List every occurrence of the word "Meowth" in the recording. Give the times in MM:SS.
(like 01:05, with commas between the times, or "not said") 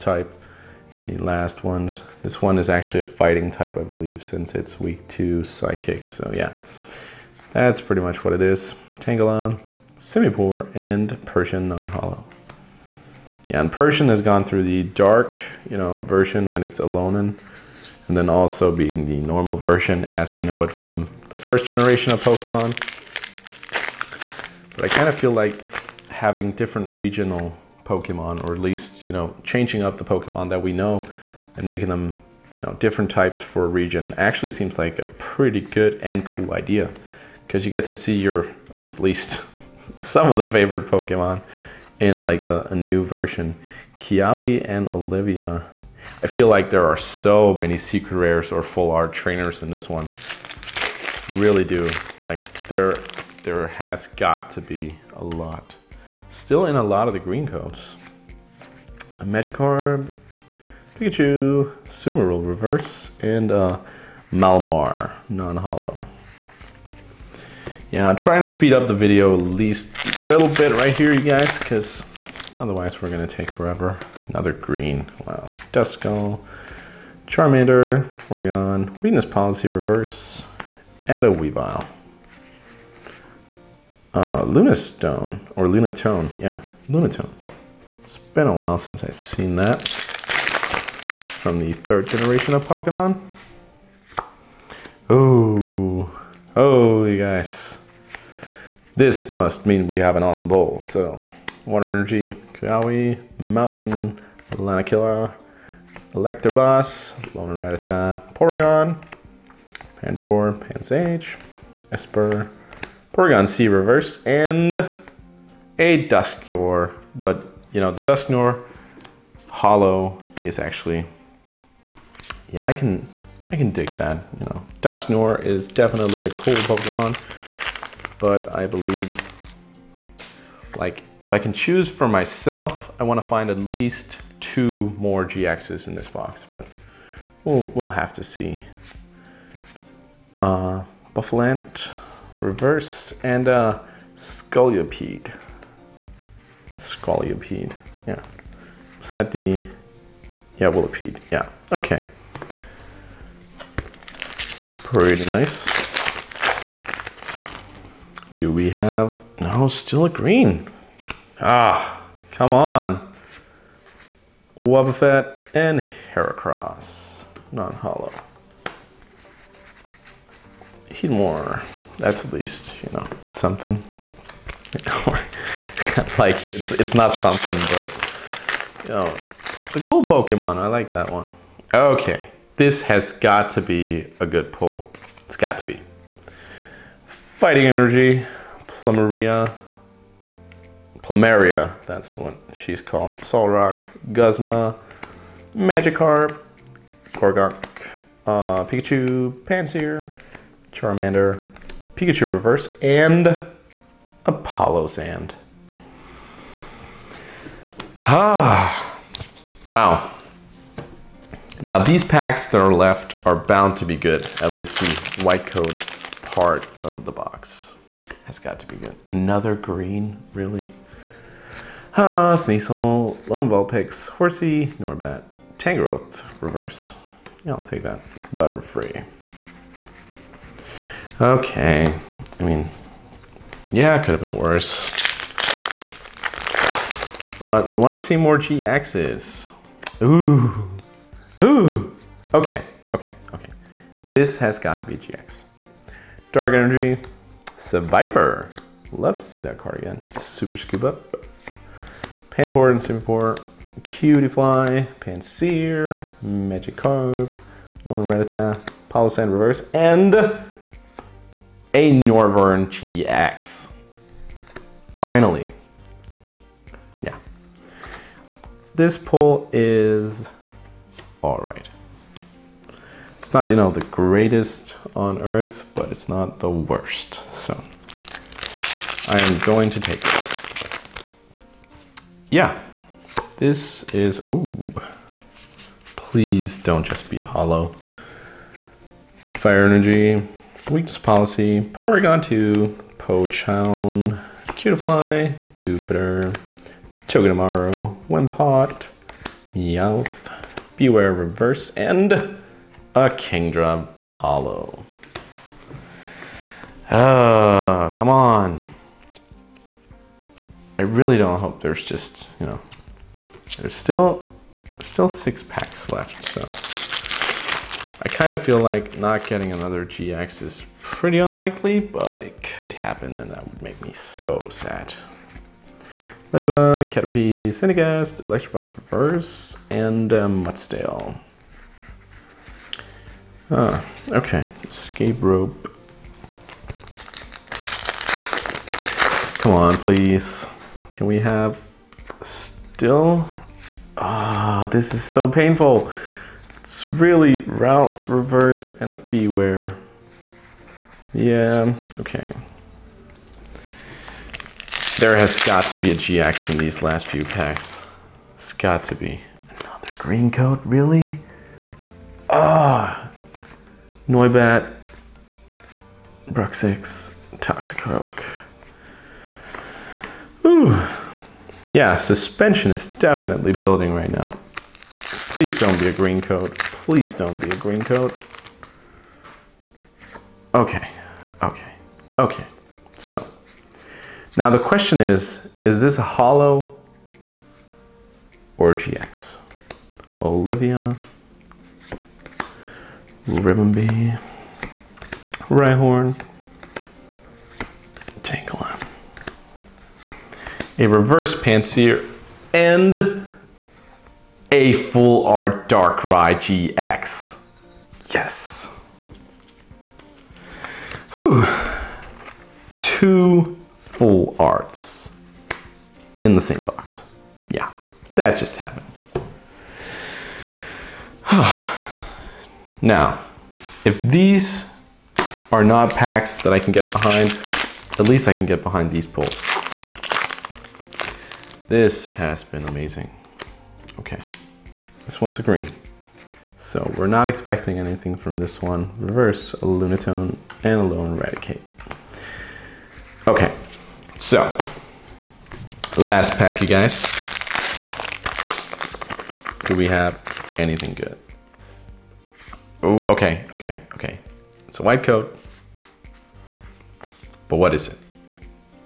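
04:59.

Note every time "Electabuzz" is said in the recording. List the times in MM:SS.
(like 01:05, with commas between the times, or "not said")
01:46, 05:28.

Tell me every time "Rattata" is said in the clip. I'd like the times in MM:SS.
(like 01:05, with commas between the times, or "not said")
01:47.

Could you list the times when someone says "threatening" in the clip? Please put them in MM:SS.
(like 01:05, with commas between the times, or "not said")
not said.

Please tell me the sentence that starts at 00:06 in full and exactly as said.
So yeah, that's pretty much what it is.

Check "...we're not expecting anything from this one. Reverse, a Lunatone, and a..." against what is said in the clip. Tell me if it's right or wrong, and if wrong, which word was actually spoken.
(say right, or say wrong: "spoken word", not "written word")
right.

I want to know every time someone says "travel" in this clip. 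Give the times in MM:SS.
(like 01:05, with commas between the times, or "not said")
not said.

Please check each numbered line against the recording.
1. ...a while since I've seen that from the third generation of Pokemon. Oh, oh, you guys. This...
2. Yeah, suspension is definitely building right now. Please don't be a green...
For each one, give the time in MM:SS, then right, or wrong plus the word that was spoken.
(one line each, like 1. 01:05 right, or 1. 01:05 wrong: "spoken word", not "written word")
1. 01:28 right
2. 06:11 right.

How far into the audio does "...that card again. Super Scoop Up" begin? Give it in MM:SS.
04:09.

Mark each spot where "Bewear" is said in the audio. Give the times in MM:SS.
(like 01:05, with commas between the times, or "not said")
05:00, 05:48.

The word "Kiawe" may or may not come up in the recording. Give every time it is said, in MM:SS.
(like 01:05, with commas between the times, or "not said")
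00:43, 01:42.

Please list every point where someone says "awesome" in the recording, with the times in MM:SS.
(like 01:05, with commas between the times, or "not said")
01:40.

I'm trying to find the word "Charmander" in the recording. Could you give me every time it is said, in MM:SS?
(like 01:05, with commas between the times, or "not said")
01:17, 03:20.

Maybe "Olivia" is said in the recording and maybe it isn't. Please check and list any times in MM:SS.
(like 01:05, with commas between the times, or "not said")
00:44, 06:30.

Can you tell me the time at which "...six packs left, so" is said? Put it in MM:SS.
05:15.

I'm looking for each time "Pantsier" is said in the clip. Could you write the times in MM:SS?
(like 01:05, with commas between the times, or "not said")
06:41.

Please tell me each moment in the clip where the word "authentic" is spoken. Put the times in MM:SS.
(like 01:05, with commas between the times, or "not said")
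not said.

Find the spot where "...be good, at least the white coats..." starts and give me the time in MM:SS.
03:33.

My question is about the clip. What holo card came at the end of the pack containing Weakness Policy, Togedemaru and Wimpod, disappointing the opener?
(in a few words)
Kingdra.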